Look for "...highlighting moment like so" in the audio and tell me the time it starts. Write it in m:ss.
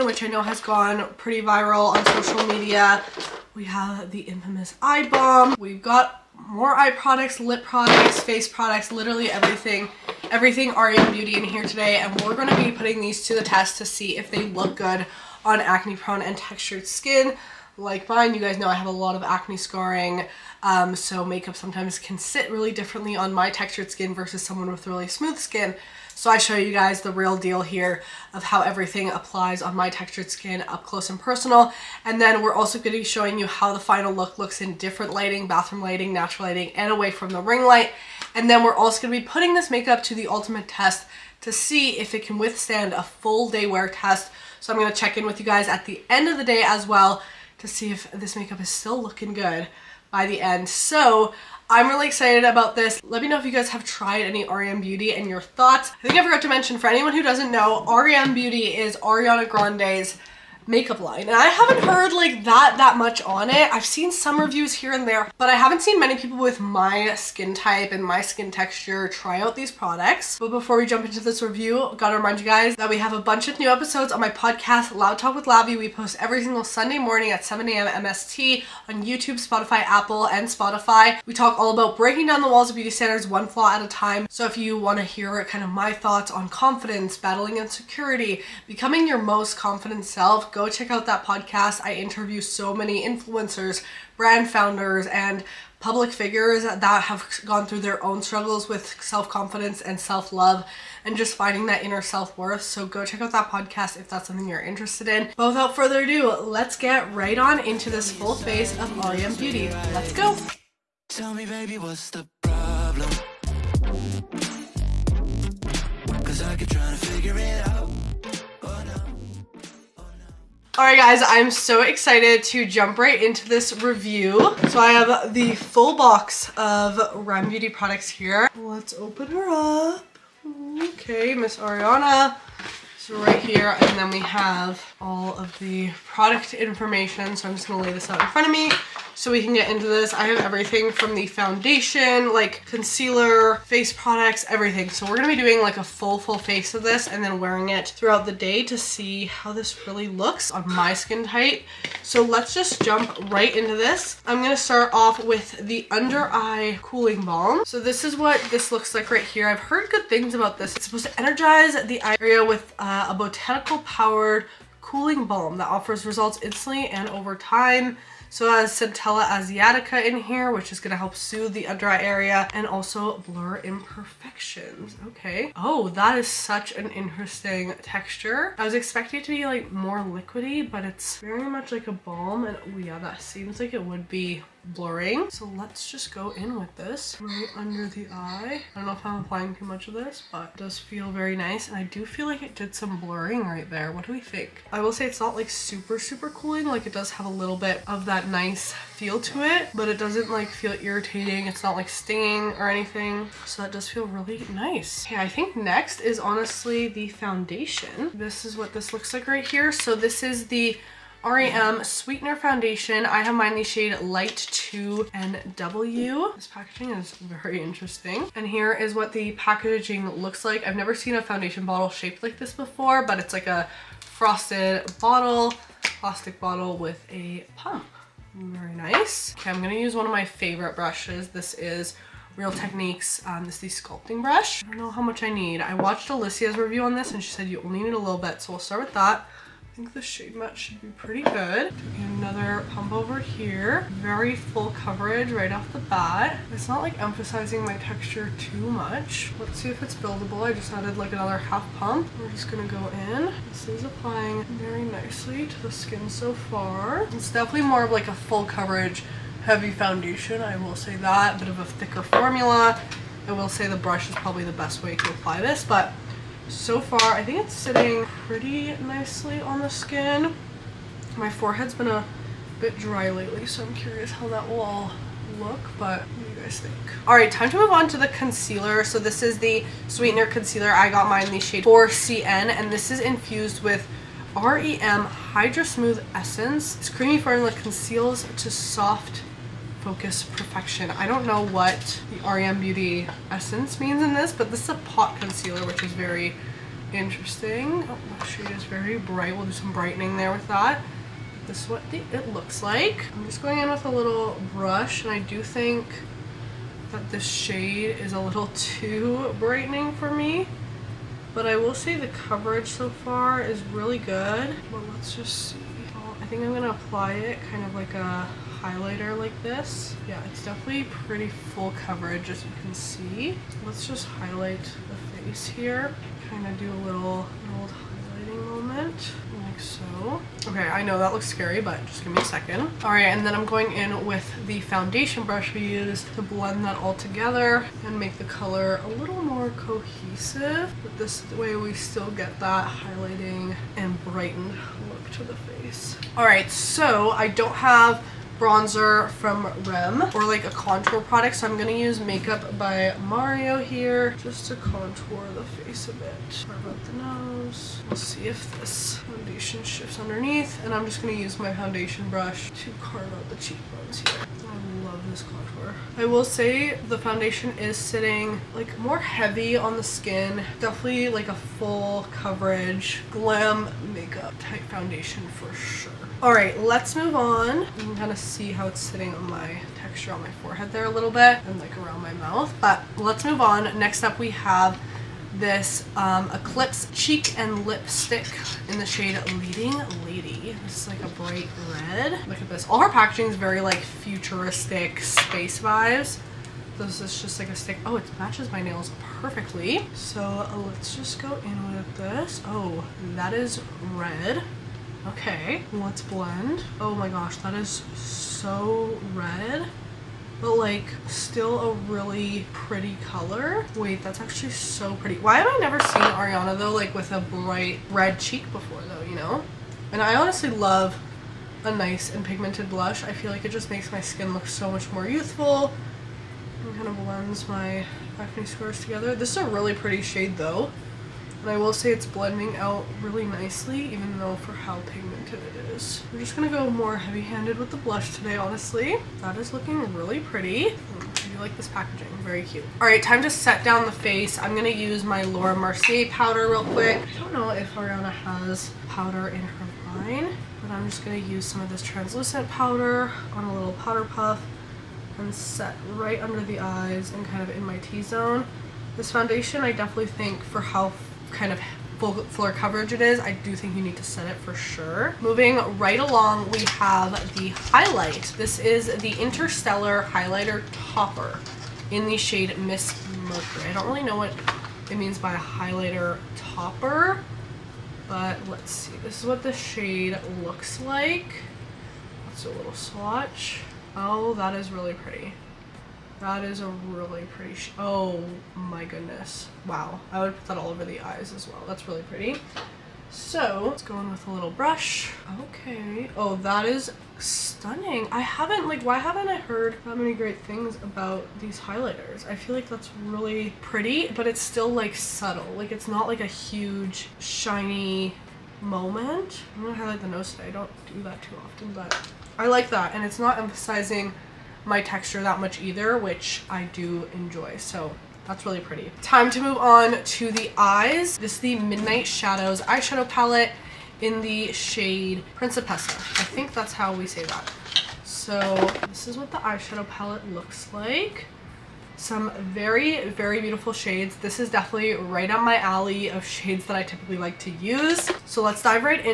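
5:27.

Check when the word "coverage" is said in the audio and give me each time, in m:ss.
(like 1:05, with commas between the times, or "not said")
4:04, 4:18, 5:12, 5:21, 6:12, 7:42.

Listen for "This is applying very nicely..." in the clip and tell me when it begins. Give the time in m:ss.
4:13.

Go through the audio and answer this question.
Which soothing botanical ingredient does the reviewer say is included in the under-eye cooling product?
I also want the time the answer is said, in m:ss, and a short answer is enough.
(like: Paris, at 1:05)
Centella Asiatica, at 2:48.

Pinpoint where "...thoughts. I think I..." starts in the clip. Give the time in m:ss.
0:55.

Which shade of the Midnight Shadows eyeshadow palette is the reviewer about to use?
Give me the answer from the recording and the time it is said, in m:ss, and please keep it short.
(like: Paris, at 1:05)
Principessa, at 8:45.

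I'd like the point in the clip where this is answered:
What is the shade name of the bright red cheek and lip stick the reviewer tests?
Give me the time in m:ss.
6:29.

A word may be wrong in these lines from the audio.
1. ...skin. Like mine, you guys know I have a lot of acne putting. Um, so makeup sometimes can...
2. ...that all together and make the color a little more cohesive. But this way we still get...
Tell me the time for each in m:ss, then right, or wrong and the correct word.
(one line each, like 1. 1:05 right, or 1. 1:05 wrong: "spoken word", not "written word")
1. 0:16 wrong: "scarring", not "putting"
2. 5:36 right.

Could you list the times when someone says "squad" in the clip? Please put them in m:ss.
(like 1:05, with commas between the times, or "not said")
not said.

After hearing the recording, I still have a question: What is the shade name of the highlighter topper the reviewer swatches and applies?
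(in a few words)
Miss Mercury.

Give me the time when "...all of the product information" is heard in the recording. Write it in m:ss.
2:15.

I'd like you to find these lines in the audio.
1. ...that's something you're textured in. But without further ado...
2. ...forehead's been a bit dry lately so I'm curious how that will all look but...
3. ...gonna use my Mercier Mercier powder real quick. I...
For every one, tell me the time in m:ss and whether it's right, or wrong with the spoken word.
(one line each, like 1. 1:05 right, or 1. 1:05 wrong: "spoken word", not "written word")
1. 1:44 wrong: "interested", not "textured"
2. 4:31 right
3. 7:24 wrong: "Laura", not "Mercier".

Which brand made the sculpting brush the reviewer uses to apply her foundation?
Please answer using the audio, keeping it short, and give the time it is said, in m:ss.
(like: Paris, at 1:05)
Real Techniques, at 3:52.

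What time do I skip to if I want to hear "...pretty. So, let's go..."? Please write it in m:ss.
8:12.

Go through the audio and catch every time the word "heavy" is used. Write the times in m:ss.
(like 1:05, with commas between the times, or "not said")
4:19, 6:08, 7:16.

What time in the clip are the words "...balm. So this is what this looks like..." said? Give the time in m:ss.
2:37.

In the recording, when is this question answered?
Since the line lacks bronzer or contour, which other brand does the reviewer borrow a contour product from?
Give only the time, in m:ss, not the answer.
5:52.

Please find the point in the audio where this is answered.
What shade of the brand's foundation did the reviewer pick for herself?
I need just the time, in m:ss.
3:34.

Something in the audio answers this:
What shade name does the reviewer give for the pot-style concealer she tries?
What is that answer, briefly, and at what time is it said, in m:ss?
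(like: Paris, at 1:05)
4CN, at 4:41.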